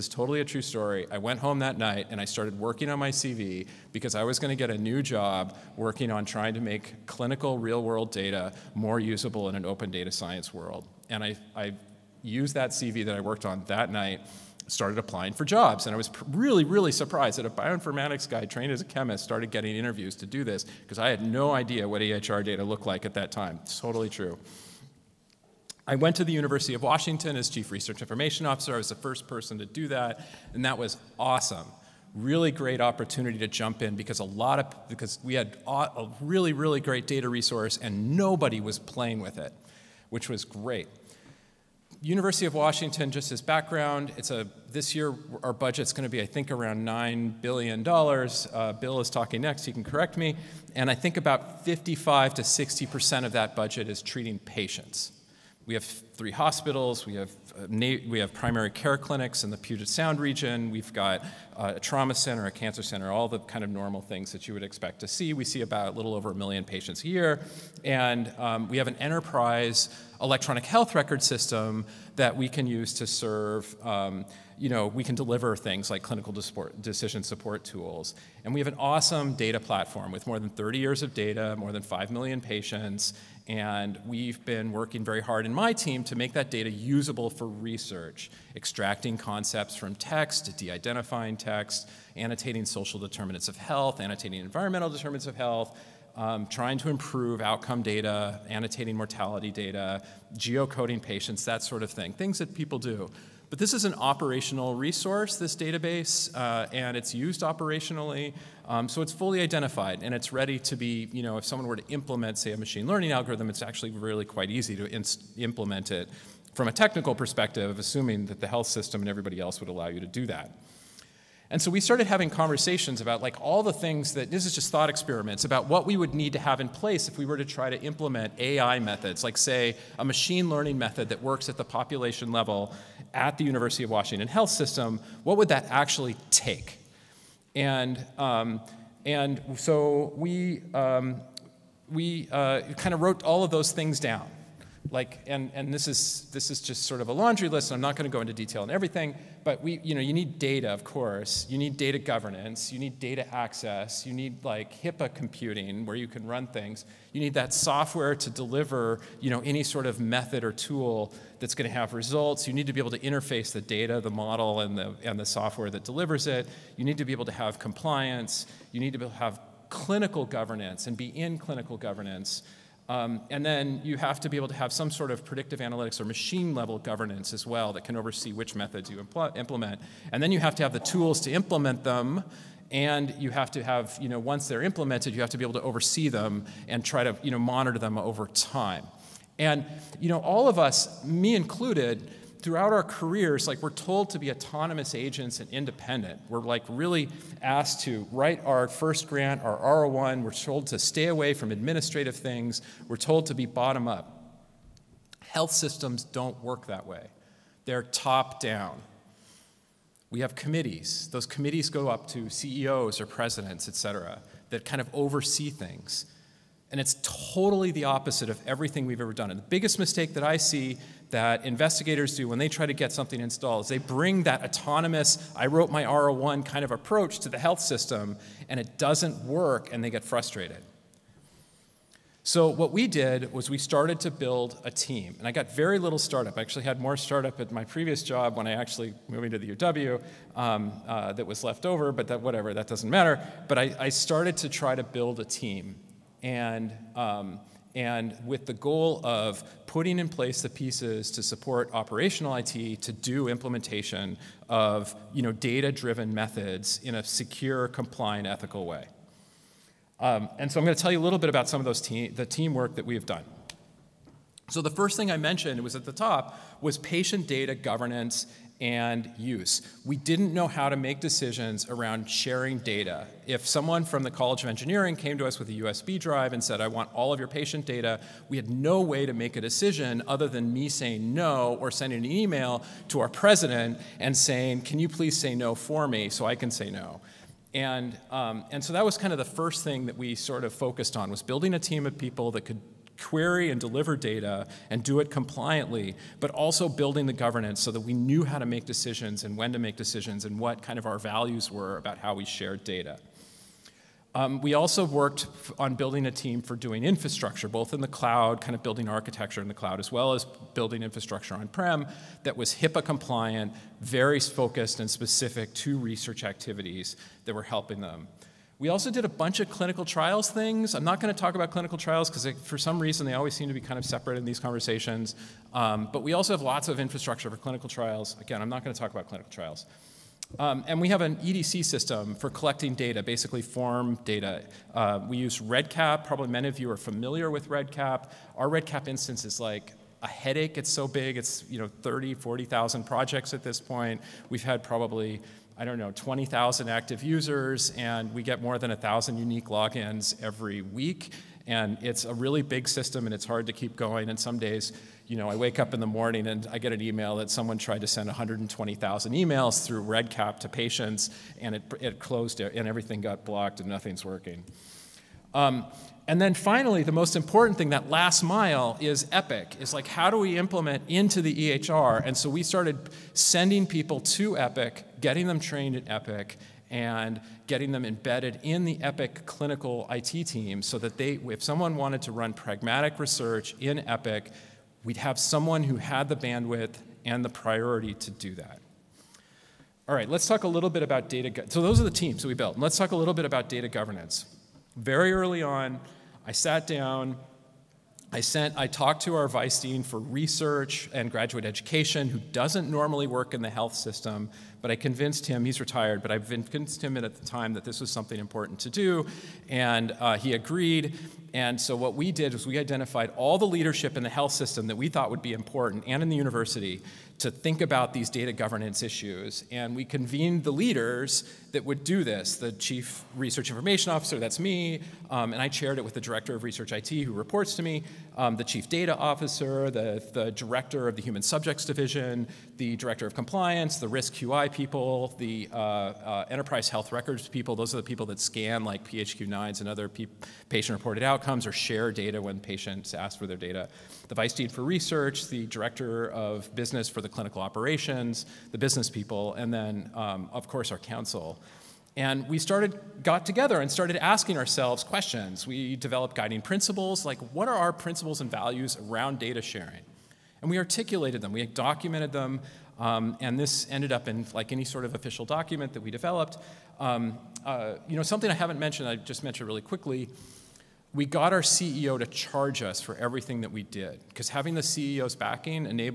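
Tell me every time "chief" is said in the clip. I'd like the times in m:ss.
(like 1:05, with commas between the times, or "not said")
0:27, 7:02, 7:08.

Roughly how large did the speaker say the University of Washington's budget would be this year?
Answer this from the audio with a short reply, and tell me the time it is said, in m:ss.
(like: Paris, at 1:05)
9 billion dollars, at 0:46.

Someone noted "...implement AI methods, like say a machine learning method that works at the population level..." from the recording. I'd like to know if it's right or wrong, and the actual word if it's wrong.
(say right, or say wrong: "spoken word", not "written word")
right.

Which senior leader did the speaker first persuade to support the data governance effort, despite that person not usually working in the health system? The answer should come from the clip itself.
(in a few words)
Vice dean for research and graduate education.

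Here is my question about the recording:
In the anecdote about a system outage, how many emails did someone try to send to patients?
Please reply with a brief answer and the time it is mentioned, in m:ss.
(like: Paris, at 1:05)
120,000, at 5:58.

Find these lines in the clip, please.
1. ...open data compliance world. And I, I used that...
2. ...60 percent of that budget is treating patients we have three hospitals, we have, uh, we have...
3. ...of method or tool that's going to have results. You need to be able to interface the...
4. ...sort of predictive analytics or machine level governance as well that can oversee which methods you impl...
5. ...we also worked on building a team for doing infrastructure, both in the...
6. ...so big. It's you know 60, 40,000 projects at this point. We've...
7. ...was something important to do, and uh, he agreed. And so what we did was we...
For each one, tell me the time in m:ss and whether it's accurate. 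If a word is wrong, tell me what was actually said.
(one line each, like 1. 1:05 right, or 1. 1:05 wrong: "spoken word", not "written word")
1. 0:09 wrong: "science", not "compliance"
2. 0:52 right
3. 2:39 right
4. 2:54 right
5. 5:04 right
6. 5:40 wrong: "30", not "60"
7. 6:47 right.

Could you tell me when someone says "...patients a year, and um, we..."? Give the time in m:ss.
1:06.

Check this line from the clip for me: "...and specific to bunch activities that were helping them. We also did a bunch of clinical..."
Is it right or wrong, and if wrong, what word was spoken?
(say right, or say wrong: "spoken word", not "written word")
wrong: "research", not "bunch".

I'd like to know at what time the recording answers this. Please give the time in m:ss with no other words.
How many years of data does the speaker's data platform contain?
1:20.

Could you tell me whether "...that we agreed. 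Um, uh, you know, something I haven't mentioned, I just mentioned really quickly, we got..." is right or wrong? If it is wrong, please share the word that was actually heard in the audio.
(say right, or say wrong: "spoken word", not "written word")
wrong: "developed", not "agreed".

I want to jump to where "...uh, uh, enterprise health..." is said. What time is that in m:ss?
7:15.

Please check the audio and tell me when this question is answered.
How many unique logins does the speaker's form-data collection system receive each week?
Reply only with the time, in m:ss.
5:48.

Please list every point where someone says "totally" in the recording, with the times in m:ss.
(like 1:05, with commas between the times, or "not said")
0:00, 0:23, 3:37.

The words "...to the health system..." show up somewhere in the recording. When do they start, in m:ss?
3:47.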